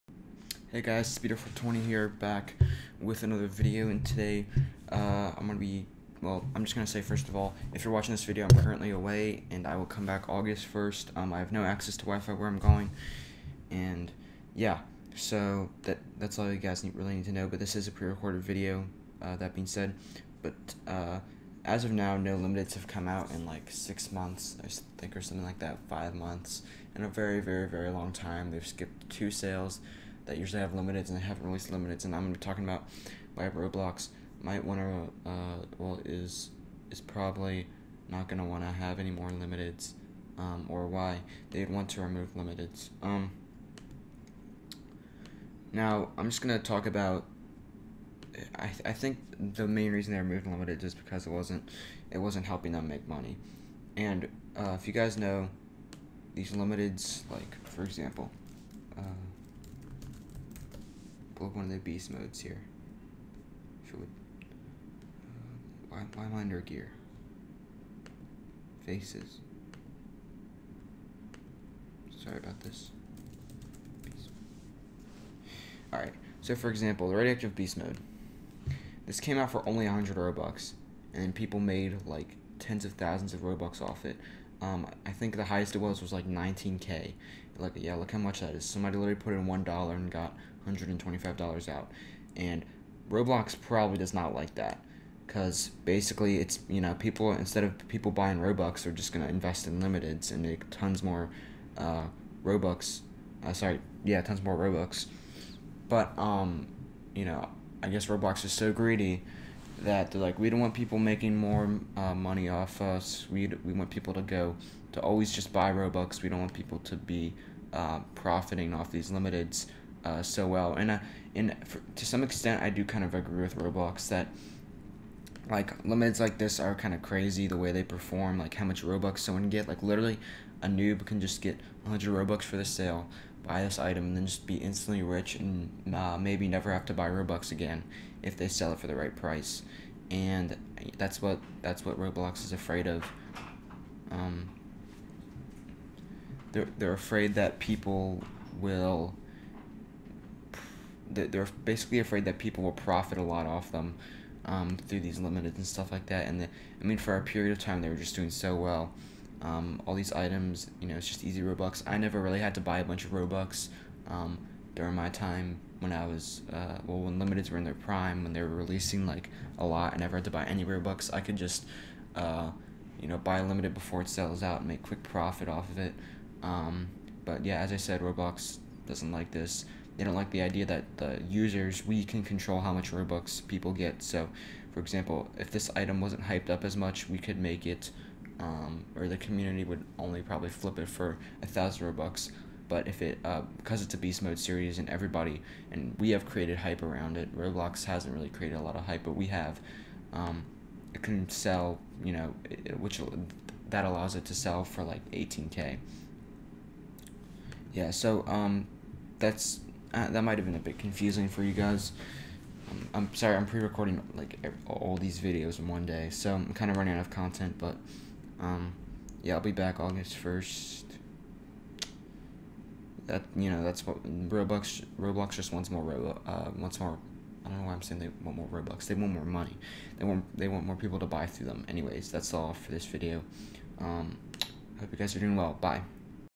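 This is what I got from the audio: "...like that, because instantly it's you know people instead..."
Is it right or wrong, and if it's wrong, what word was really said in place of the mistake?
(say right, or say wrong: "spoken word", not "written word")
wrong: "basically", not "instantly".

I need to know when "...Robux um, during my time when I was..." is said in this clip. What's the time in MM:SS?
02:43.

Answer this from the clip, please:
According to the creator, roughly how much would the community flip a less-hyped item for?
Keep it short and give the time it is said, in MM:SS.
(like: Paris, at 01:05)
1000 Robux, at 03:11.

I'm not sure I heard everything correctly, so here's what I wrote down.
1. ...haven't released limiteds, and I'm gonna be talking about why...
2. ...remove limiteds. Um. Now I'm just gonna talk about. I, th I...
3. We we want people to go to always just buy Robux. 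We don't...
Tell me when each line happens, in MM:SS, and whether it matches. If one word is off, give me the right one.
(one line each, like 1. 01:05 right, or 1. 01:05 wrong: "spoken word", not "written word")
1. 00:31 right
2. 00:42 right
3. 01:53 right.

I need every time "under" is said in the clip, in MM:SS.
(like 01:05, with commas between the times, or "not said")
01:06.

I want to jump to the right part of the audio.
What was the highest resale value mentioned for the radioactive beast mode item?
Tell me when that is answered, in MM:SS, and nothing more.
01:26.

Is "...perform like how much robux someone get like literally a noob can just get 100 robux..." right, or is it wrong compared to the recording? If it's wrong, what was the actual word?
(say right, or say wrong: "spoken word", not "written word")
right.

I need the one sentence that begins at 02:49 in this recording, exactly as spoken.
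I never had to buy any Robux.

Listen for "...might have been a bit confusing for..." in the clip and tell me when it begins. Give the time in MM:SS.
03:30.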